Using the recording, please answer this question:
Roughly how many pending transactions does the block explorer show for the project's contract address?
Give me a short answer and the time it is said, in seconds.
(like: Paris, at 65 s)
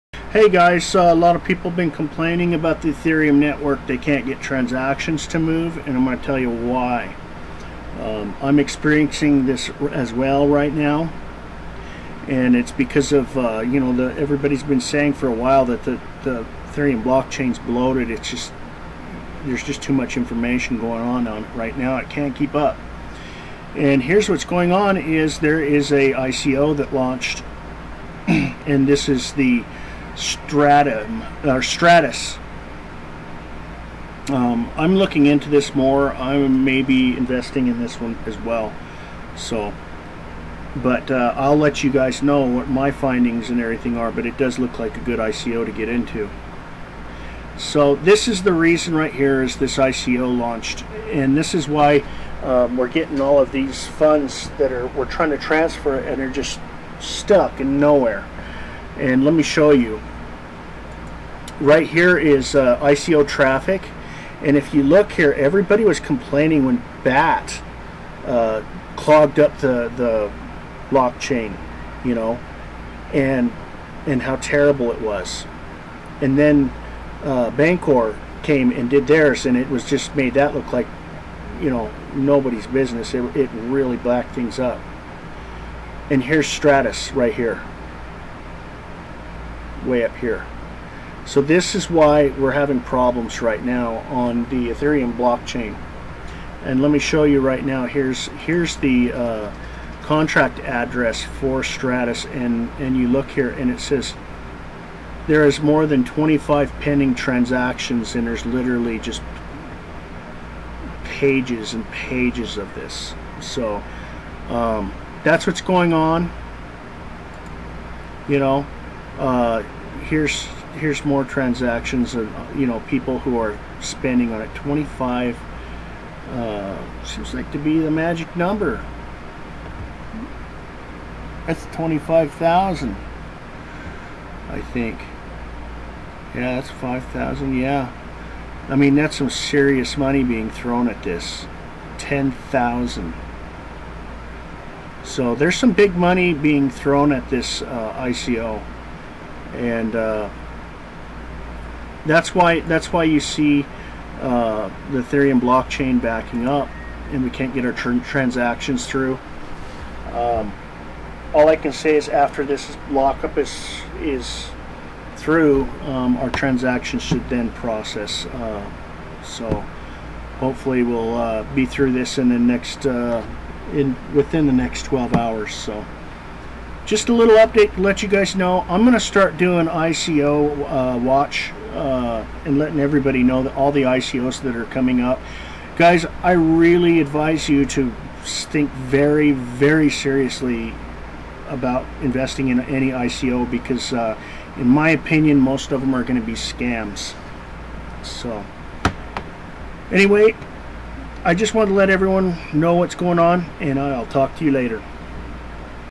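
more than 25, at 105 s.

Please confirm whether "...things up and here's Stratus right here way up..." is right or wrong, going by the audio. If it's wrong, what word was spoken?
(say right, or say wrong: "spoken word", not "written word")
right.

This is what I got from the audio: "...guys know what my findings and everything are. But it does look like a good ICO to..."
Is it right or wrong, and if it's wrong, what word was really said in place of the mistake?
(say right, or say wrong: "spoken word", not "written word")
right.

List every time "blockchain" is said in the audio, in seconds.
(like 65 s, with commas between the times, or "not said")
17 s, 70 s, 95 s, 155 s.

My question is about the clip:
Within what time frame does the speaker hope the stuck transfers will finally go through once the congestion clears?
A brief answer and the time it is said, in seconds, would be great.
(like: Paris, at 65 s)
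12 hours, at 174 s.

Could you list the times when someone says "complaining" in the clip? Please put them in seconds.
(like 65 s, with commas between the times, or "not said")
1 s, 65 s.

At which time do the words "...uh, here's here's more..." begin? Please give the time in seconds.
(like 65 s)
119 s.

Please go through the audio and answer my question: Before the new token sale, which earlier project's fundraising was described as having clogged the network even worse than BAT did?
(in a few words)
Bancor.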